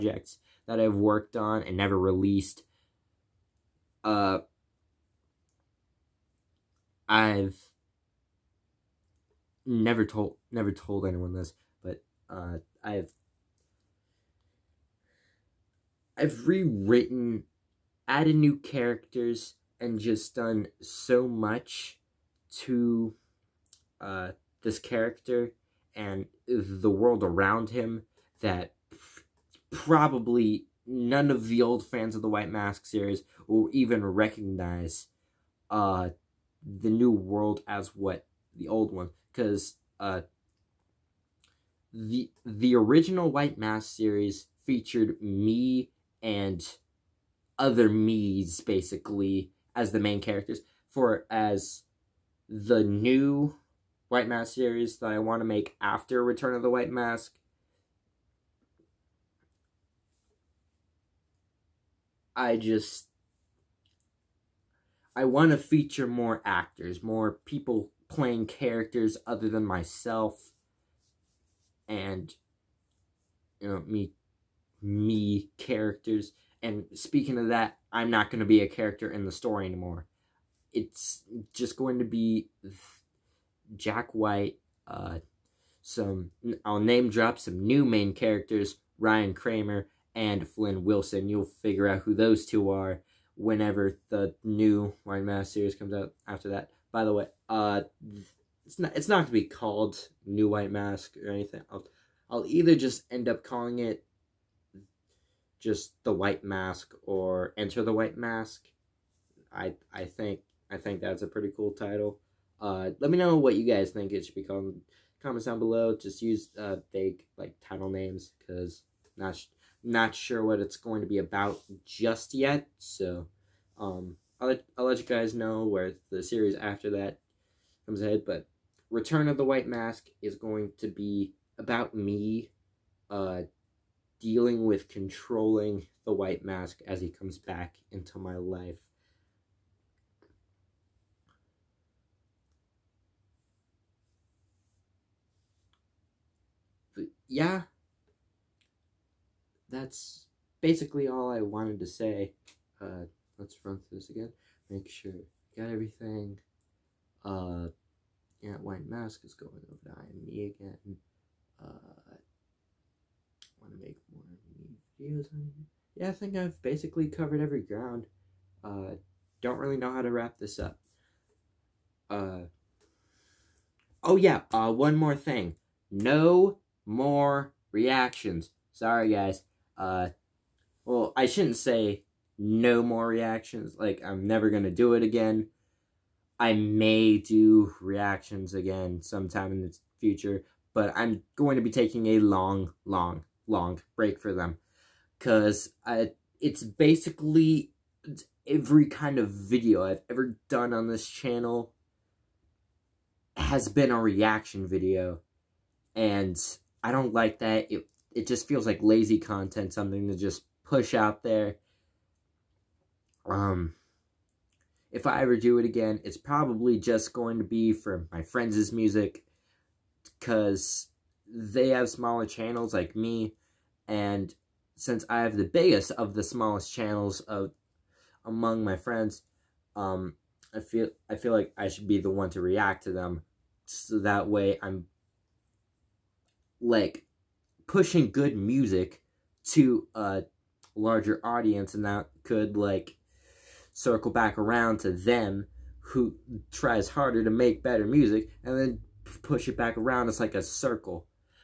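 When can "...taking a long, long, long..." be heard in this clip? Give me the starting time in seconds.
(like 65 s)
191 s.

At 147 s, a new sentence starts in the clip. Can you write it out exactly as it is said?
yeah, that's basically all I wanted to say.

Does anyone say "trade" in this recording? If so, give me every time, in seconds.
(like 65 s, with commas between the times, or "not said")
not said.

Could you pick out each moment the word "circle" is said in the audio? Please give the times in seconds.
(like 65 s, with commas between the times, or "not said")
243 s, 250 s.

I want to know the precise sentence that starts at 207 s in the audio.
It it just feels like lazy content, something to just push out there.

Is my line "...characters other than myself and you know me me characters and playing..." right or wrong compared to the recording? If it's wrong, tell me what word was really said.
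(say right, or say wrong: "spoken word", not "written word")
wrong: "speaking", not "playing".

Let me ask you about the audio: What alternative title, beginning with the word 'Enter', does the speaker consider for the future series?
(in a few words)
Enter the White Mask.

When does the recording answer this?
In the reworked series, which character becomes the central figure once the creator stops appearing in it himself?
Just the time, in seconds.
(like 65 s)
83 s.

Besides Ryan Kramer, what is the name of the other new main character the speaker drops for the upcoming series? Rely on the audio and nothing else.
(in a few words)
Flynn Wilson.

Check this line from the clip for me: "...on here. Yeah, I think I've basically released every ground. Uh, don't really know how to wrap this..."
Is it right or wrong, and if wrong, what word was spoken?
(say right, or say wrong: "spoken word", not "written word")
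wrong: "covered", not "released".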